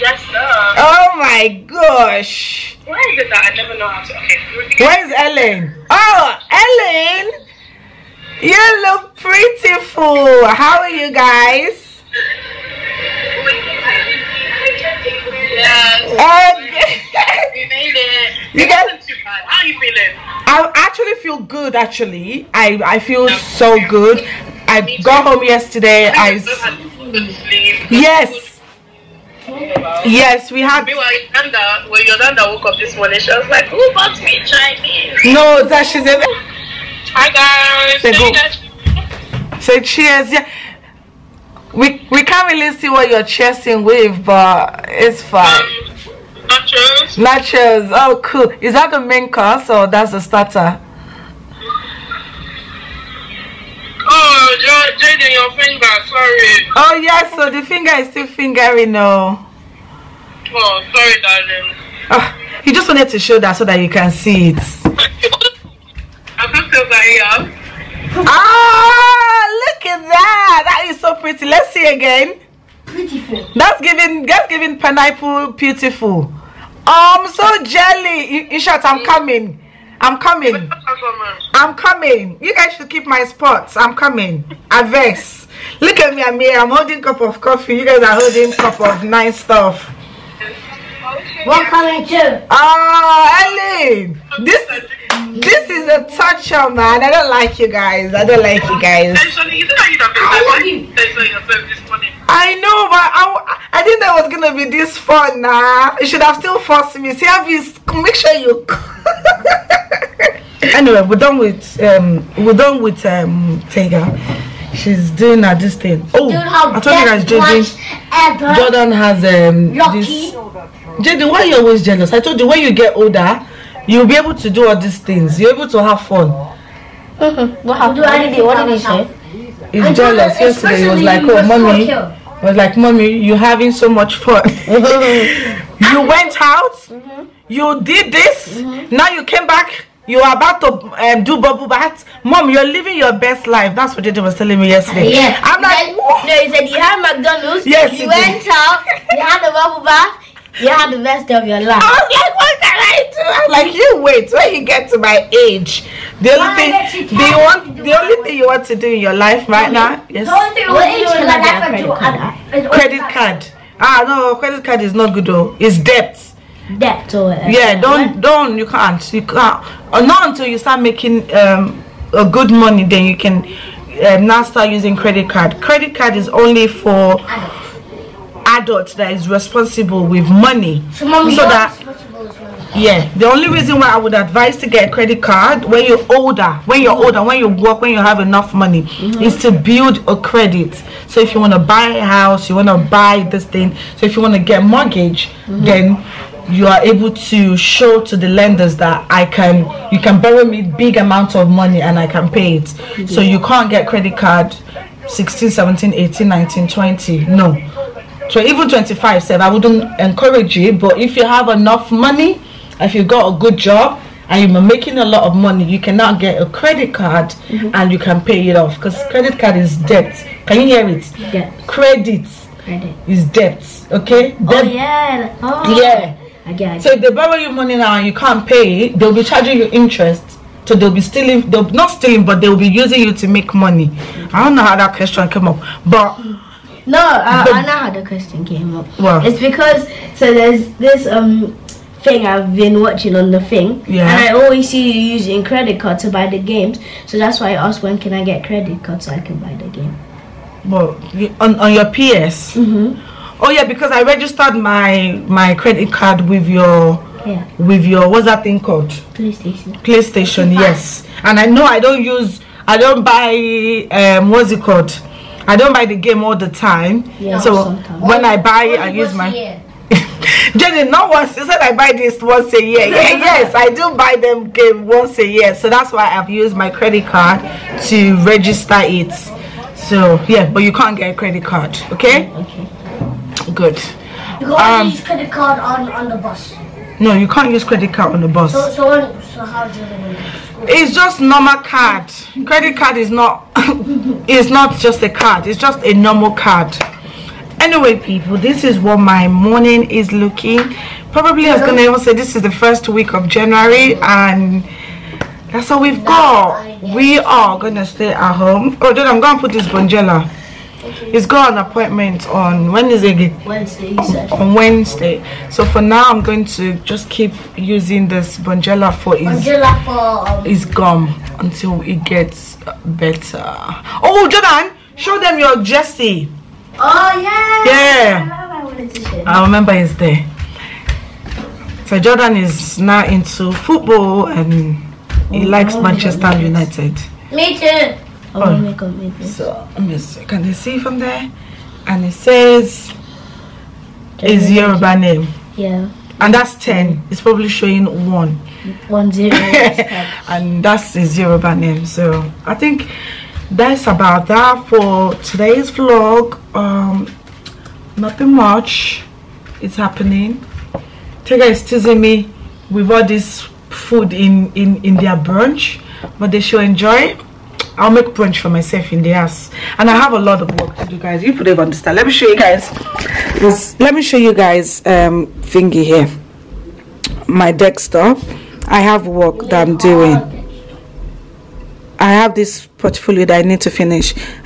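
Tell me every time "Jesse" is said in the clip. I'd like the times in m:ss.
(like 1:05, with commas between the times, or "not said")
5:25.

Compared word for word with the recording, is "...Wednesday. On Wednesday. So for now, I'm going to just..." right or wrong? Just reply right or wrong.
right.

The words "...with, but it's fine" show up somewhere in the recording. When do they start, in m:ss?
0:43.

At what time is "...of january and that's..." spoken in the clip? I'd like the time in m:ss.
5:03.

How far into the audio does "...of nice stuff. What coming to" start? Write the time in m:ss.
1:28.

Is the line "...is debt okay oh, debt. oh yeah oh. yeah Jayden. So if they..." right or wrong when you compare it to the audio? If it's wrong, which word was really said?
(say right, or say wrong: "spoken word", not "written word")
wrong: "Again", not "Jayden".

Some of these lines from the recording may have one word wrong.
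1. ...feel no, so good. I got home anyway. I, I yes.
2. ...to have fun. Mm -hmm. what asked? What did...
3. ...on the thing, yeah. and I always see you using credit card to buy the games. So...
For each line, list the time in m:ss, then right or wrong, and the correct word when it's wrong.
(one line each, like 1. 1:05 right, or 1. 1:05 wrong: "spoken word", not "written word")
1. 0:22 wrong: "yesterday", not "anyway"
2. 2:05 wrong: "happened", not "asked"
3. 4:03 right.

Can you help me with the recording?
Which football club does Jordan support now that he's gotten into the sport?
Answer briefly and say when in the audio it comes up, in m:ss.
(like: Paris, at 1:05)
Manchester United, at 5:35.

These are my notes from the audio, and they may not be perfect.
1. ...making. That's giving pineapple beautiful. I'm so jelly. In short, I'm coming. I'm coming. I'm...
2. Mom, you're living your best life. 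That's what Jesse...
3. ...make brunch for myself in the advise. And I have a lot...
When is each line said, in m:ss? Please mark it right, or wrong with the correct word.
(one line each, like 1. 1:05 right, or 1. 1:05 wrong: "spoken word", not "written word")
1. 1:13 wrong: "giving", not "making"
2. 2:22 wrong: "Jayden", not "Jesse"
3. 6:07 wrong: "house", not "advise".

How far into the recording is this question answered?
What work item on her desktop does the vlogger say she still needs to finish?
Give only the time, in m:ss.
6:22.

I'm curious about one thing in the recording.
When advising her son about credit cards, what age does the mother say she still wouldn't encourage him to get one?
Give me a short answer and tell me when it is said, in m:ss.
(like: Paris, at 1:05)
25, at 3:28.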